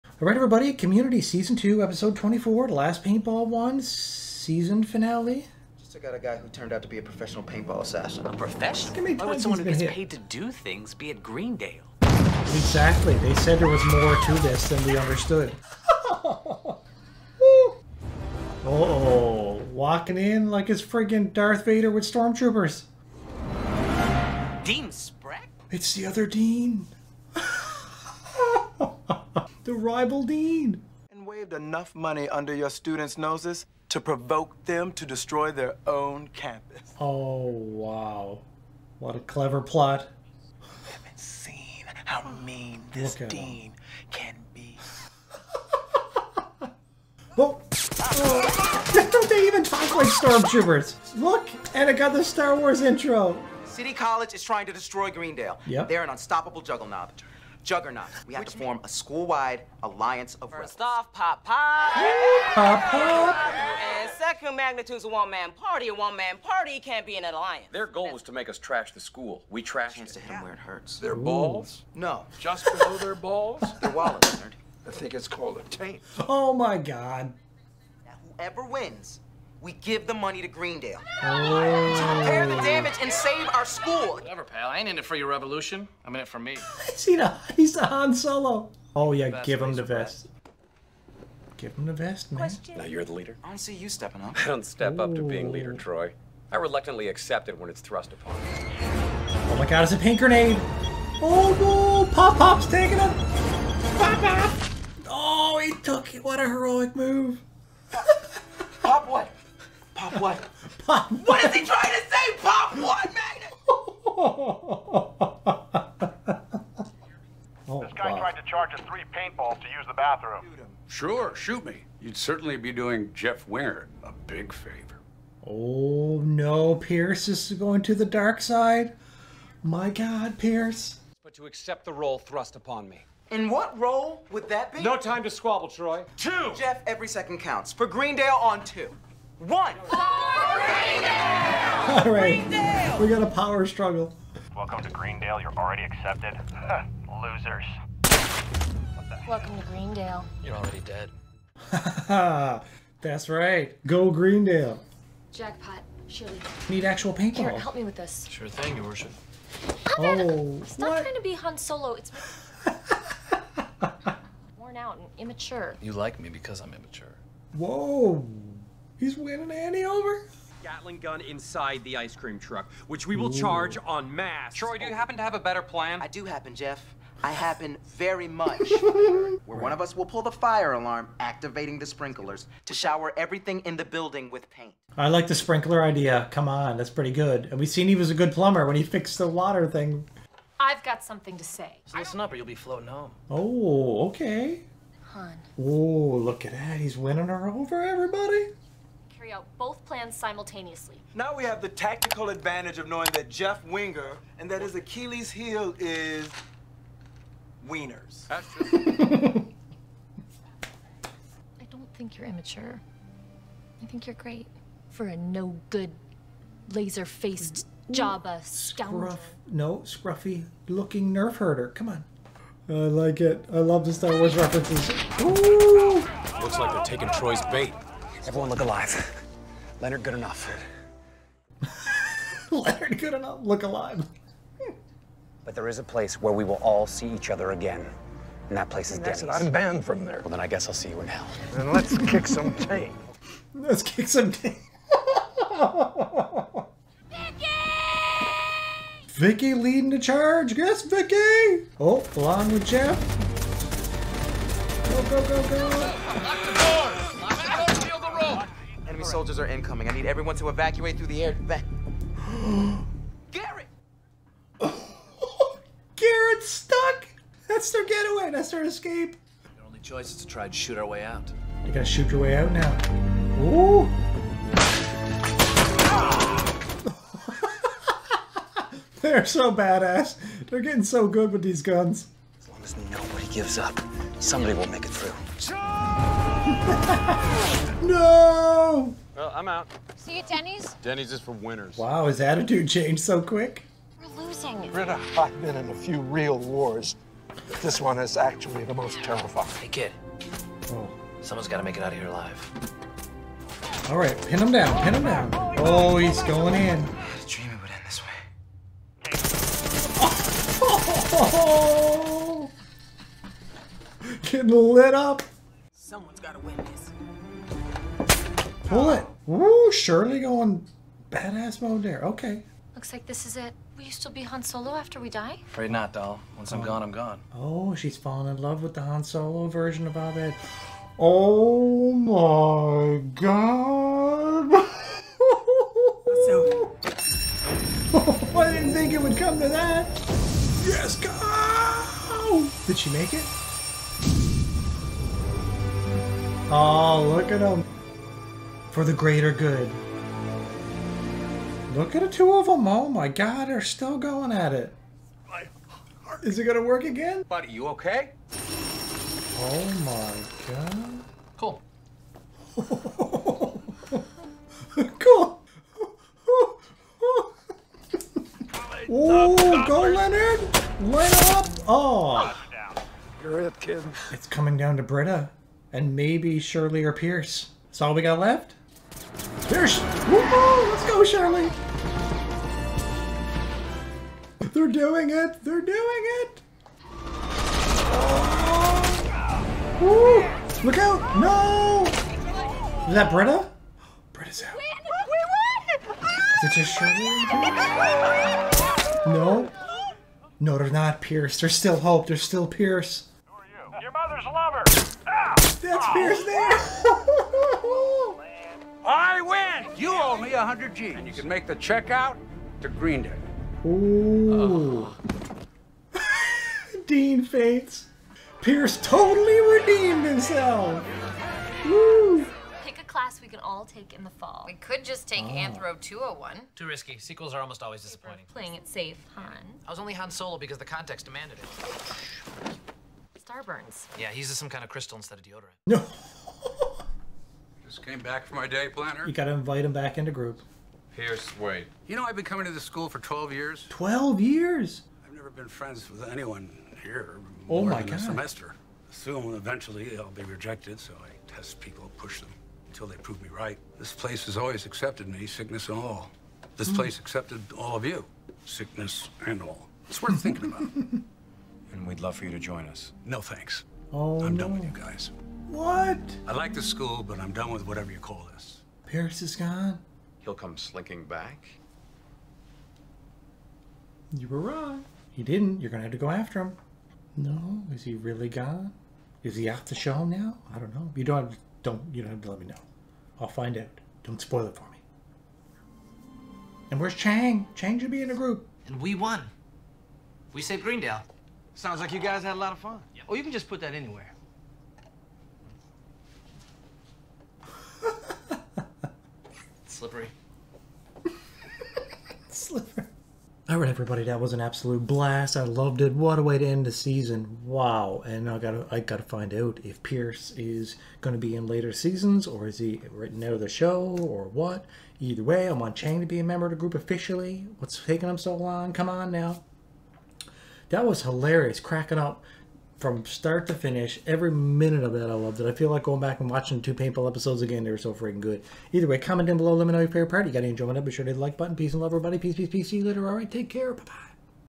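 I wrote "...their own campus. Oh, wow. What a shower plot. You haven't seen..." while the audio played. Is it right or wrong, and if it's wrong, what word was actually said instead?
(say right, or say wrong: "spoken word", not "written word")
wrong: "clever", not "shower".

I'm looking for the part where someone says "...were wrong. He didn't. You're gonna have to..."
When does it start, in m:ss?
7:54.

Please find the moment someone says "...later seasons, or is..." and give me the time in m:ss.
8:31.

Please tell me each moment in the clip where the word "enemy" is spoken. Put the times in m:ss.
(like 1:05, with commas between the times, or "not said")
4:19.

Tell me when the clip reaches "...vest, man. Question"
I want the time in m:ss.
1:31.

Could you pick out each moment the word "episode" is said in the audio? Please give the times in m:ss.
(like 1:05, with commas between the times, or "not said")
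0:01, 8:47.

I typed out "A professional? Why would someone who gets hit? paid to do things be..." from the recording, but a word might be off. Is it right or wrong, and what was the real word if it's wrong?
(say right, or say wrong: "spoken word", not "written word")
right.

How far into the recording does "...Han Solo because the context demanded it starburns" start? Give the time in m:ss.
7:09.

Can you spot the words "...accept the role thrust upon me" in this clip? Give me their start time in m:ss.
2:11.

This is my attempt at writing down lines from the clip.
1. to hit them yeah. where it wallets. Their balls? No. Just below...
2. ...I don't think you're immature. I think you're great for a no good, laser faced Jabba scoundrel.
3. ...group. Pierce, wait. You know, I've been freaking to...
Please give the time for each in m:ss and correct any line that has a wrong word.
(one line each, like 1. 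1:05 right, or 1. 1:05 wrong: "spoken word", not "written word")
1. 1:10 wrong: "hurts", not "wallets"
2. 3:31 right
3. 7:20 wrong: "coming", not "freaking".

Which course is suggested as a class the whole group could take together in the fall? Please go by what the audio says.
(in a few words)
Anthro 201.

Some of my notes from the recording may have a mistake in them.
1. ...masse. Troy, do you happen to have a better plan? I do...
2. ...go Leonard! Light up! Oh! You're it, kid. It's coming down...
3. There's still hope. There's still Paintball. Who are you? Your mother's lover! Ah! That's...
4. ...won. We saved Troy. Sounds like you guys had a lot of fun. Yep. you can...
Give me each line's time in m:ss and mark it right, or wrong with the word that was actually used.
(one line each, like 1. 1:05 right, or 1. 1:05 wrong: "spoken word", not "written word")
1. 2:54 right
2. 6:09 right
3. 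6:41 wrong: "Pierce", not "Paintball"
4. 8:08 wrong: "Greendale", not "Troy".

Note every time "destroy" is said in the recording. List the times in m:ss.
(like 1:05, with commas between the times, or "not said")
0:35, 0:54.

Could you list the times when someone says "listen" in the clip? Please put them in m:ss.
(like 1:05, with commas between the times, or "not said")
3:11.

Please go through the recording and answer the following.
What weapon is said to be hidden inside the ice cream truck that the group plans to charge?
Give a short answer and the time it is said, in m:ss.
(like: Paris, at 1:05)
Gatling gun, at 2:50.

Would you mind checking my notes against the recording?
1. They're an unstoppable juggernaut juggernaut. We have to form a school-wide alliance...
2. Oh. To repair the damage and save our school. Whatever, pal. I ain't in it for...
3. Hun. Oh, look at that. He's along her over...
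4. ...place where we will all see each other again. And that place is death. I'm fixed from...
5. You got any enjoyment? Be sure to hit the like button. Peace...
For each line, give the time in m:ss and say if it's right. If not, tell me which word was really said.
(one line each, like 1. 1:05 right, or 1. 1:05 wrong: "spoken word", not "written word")
1. 0:55 right
2. 1:21 right
3. 3:15 wrong: "winning", not "along"
4. 3:55 wrong: "banned", not "fixed"
5. 8:50 right.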